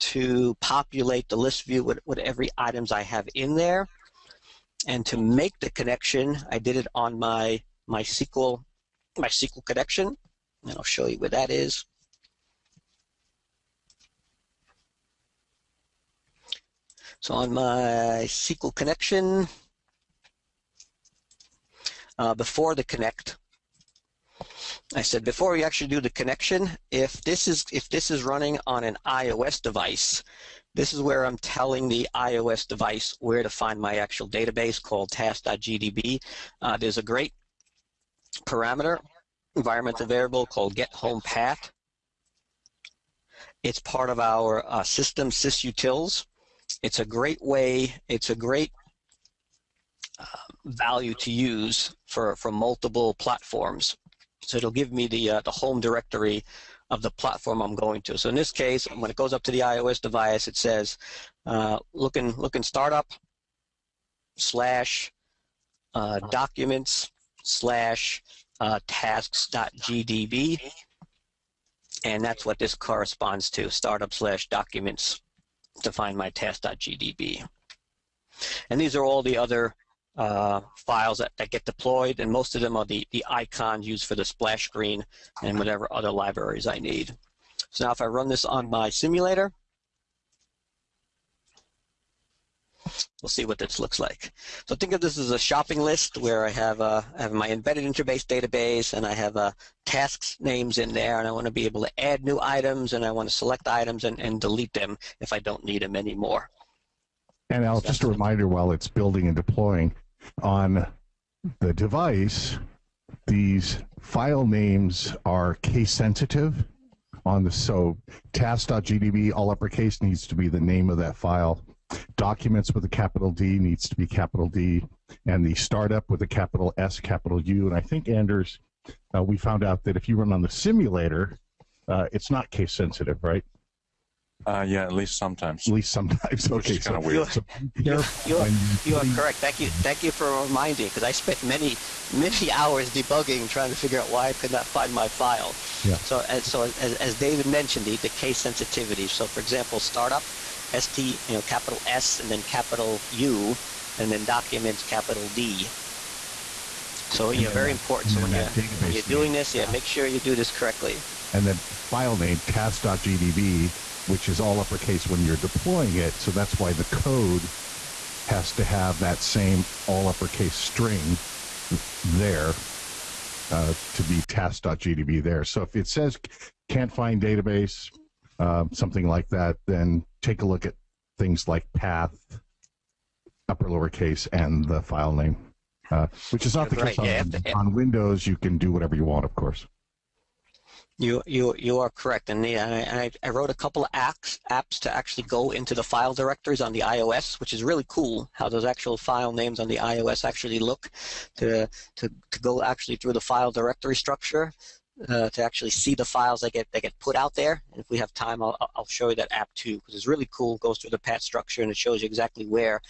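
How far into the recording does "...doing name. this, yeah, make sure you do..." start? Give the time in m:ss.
2:39.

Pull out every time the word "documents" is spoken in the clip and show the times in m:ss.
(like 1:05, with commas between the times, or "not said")
1:06, 1:14, 2:02, 2:34.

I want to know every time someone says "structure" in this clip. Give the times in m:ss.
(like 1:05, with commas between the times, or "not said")
3:23, 3:31.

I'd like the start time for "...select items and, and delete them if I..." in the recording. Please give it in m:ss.
1:43.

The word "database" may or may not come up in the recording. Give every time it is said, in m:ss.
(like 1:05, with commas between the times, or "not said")
0:34, 1:38, 2:57.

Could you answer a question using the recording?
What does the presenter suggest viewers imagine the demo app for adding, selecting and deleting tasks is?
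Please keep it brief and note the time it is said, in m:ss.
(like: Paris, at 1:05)
a shopping list, at 1:35.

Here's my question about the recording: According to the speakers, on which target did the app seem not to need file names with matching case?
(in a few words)
the simulator.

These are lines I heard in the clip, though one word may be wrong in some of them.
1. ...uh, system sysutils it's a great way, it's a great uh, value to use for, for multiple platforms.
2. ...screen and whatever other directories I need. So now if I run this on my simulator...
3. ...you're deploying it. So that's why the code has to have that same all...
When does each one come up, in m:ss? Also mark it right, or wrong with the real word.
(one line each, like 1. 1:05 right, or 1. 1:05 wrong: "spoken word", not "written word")
1. 0:44 right
2. 1:24 wrong: "libraries", not "directories"
3. 2:45 right.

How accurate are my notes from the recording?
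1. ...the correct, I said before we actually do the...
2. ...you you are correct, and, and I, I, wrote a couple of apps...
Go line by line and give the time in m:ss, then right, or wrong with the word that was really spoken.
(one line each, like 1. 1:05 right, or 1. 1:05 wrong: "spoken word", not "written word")
1. 0:22 wrong: "connect", not "correct"
2. 3:11 right.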